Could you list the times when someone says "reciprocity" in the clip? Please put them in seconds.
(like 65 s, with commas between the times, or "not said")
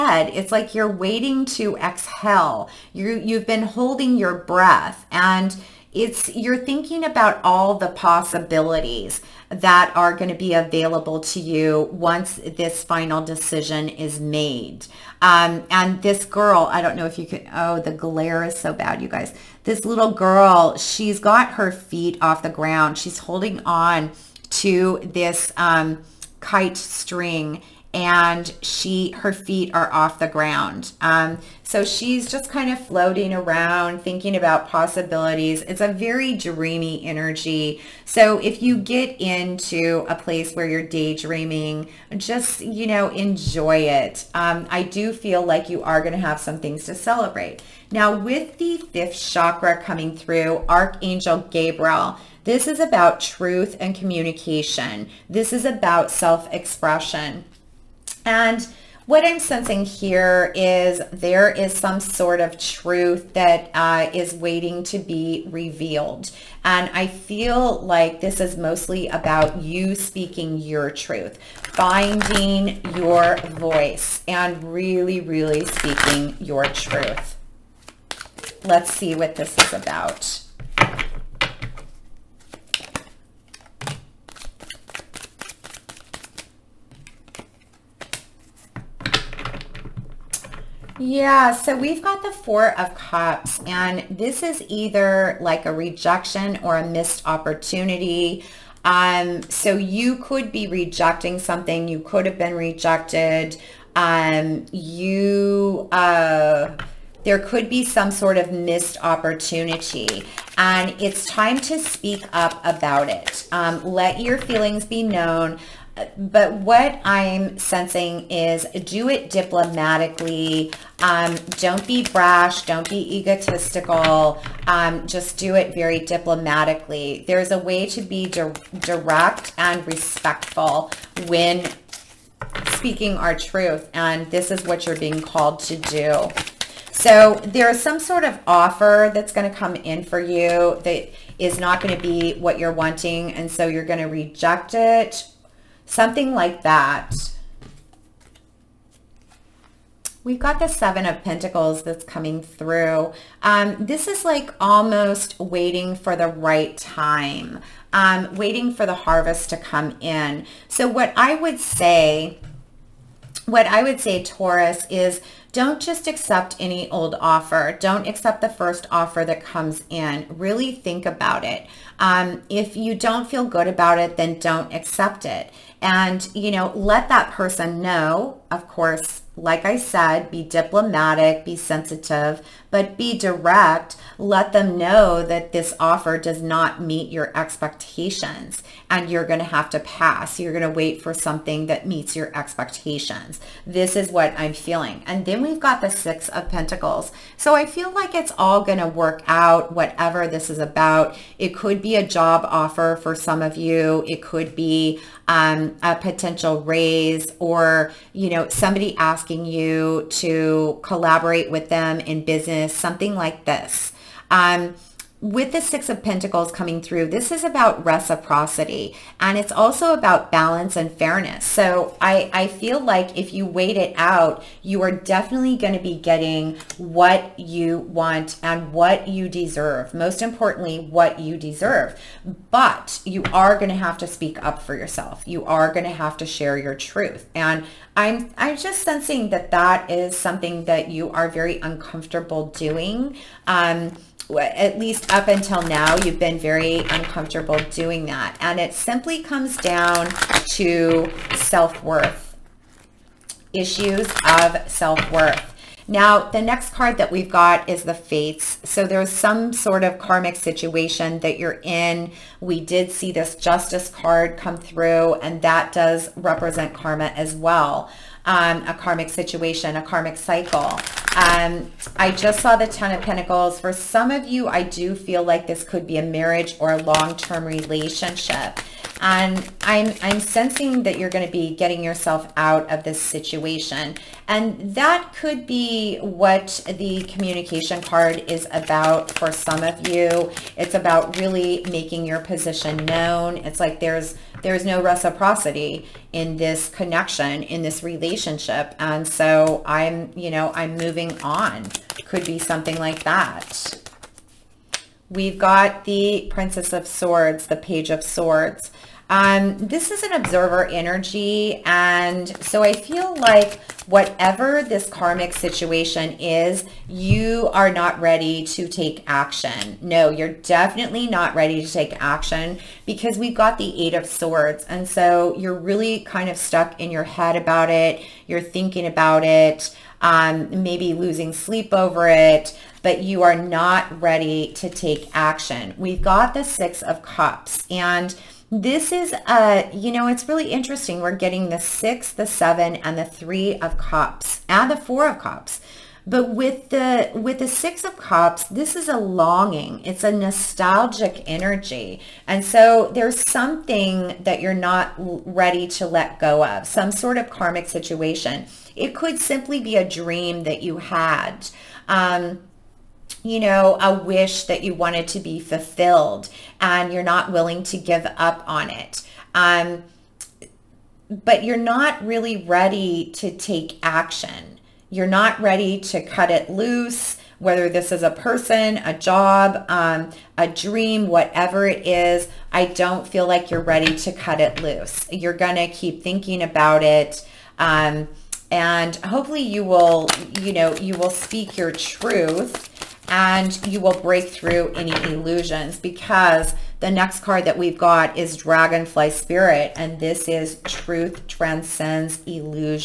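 217 s, 294 s.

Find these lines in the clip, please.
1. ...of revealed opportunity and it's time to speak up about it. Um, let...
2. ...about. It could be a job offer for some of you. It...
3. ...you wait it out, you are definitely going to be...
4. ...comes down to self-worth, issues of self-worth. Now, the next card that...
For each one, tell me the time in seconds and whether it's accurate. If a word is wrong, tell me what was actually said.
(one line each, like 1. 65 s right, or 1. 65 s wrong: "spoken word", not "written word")
1. 108 s wrong: "missed", not "revealed"
2. 200 s right
3. 223 s right
4. 249 s right.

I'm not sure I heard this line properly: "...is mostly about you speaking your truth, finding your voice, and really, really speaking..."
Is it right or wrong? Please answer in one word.
right.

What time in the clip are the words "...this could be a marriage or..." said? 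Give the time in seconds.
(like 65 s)
275 s.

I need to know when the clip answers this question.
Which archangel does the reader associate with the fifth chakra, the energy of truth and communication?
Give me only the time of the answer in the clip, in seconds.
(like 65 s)
50 s.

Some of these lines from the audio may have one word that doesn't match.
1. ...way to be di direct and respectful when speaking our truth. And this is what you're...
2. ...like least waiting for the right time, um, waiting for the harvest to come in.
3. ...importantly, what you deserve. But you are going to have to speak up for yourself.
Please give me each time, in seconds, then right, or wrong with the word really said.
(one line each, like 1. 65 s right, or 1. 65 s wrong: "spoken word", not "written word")
1. 127 s right
2. 154 s wrong: "almost", not "least"
3. 230 s right.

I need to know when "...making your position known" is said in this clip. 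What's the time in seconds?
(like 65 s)
291 s.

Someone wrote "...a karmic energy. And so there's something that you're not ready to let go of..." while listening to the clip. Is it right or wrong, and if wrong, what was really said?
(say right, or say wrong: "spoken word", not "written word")
wrong: "nostalgic", not "karmic".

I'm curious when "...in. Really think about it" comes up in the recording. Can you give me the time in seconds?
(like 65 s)
169 s.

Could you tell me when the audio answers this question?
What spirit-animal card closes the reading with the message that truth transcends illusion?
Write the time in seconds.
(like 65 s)
398 s.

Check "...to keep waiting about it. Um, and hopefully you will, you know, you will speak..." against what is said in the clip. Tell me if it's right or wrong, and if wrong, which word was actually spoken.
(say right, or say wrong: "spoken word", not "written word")
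wrong: "thinking", not "waiting".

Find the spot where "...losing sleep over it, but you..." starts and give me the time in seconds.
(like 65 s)
330 s.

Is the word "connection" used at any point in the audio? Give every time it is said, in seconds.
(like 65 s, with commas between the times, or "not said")
296 s.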